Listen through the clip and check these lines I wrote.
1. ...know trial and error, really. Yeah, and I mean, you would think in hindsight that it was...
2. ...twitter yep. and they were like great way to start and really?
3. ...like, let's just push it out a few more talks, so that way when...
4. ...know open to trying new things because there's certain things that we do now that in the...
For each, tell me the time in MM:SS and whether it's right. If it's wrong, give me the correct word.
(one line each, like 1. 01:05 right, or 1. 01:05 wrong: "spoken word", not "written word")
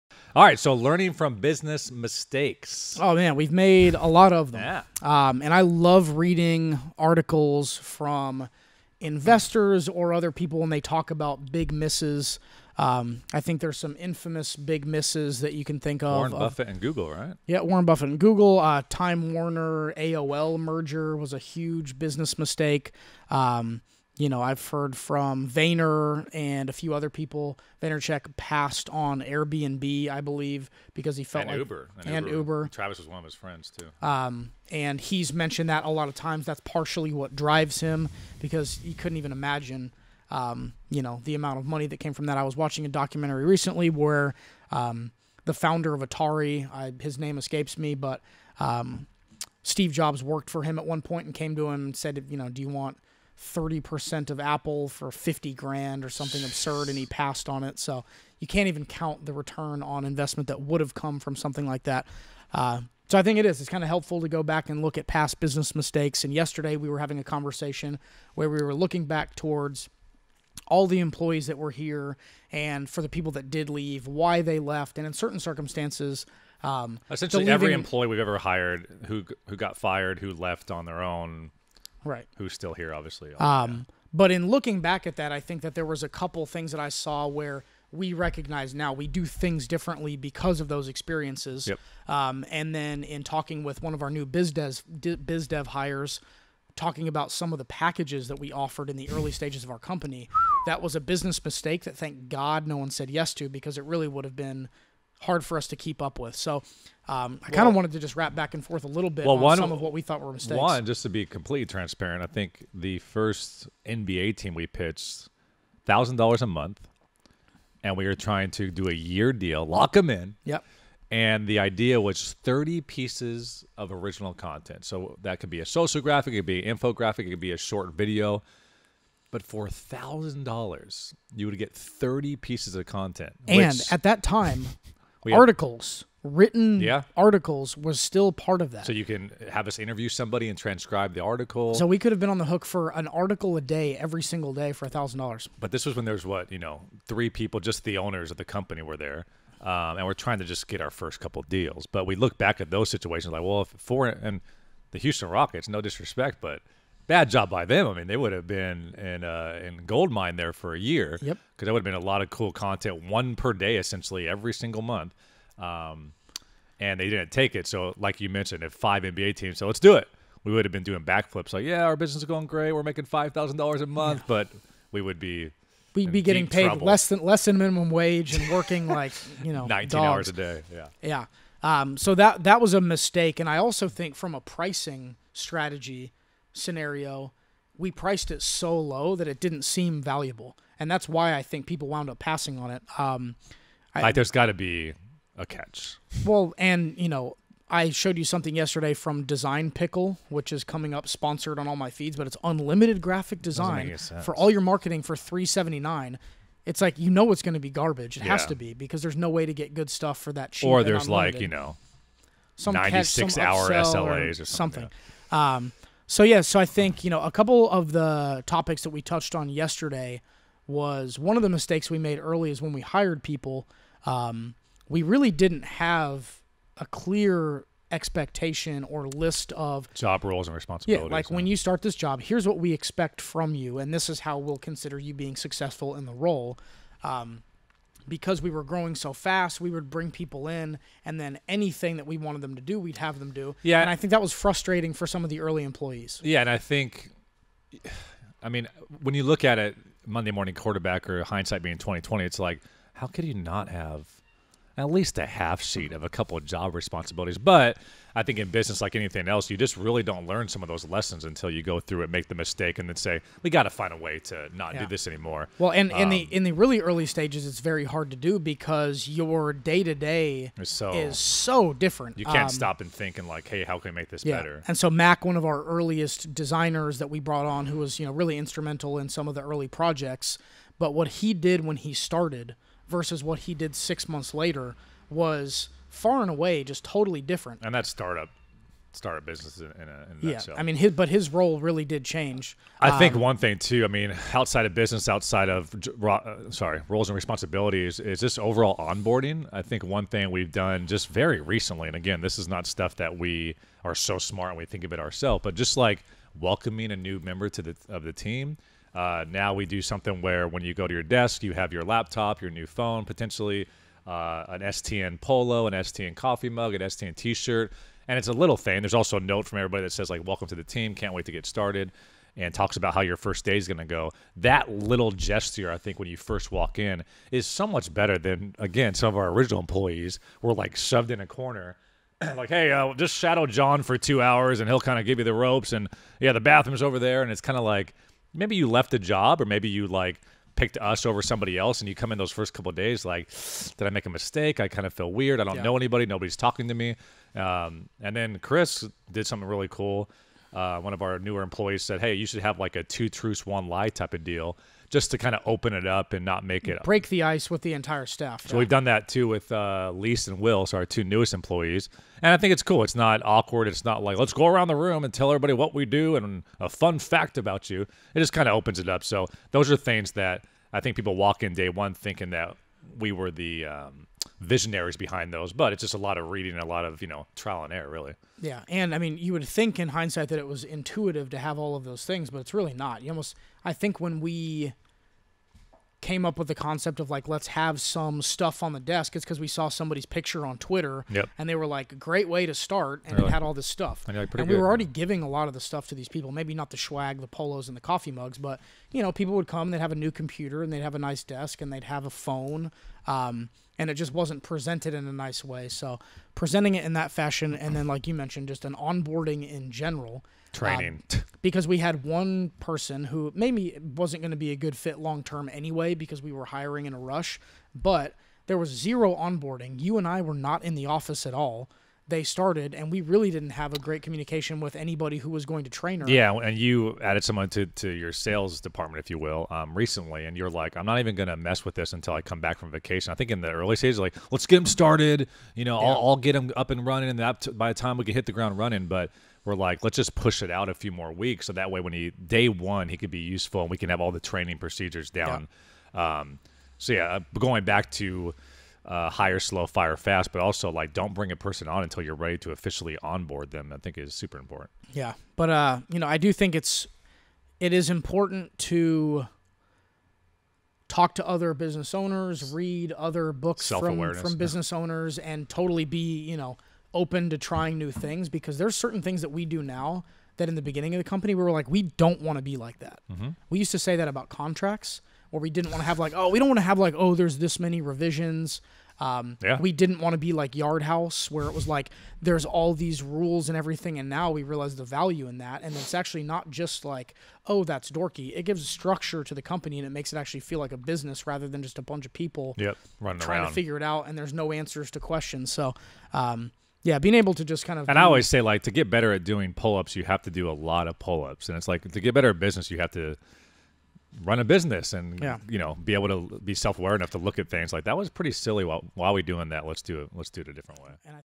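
1. 06:17 right
2. 06:30 right
3. 07:19 wrong: "weeks", not "talks"
4. 07:46 right.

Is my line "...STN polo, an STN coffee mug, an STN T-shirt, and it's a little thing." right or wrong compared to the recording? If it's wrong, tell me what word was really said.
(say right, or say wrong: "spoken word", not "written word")
right.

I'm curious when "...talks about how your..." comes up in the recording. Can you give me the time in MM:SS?
05:22.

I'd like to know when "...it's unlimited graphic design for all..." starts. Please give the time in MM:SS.
03:22.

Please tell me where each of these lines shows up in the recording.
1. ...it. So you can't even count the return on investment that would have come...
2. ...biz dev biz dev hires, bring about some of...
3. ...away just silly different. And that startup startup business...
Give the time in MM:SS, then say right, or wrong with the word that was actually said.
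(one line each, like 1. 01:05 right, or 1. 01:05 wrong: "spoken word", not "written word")
1. 00:57 right
2. 01:34 wrong: "talking", not "bring"
3. 04:46 wrong: "totally", not "silly".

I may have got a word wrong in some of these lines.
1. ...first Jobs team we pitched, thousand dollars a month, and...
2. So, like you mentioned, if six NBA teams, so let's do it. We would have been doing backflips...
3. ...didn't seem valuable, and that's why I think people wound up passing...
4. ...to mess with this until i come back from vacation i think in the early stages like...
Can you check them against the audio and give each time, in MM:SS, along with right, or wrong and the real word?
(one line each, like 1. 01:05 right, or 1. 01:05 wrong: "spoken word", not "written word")
1. 01:52 wrong: "NBA", not "Jobs"
2. 02:47 wrong: "five", not "six"
3. 03:09 right
4. 07:11 right.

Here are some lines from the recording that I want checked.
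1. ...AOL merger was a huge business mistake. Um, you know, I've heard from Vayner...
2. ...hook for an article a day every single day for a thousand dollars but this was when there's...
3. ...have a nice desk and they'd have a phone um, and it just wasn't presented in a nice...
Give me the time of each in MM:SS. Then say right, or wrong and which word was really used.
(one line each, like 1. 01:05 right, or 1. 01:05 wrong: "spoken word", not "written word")
1. 00:19 right
2. 02:22 right
3. 06:40 right.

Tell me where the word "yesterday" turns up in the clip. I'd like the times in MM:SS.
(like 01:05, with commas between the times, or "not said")
01:06, 03:18, 03:39.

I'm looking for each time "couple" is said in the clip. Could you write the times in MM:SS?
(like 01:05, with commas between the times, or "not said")
01:26, 02:31, 03:37, 04:16, 05:42.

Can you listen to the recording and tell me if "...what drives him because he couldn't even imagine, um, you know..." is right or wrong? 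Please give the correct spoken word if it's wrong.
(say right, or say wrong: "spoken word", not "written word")
right.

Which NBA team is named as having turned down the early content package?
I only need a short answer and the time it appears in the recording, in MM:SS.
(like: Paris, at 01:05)
Houston Rockets, at 02:34.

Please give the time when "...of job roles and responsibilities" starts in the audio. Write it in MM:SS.
03:49.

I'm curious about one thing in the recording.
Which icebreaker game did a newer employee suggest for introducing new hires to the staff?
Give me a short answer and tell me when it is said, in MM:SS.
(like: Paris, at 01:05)
Two truths one lie, at 05:52.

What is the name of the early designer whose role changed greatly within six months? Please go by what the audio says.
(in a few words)
Mac.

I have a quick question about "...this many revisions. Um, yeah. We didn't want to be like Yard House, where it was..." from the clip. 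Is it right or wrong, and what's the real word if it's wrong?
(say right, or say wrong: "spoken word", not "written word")
right.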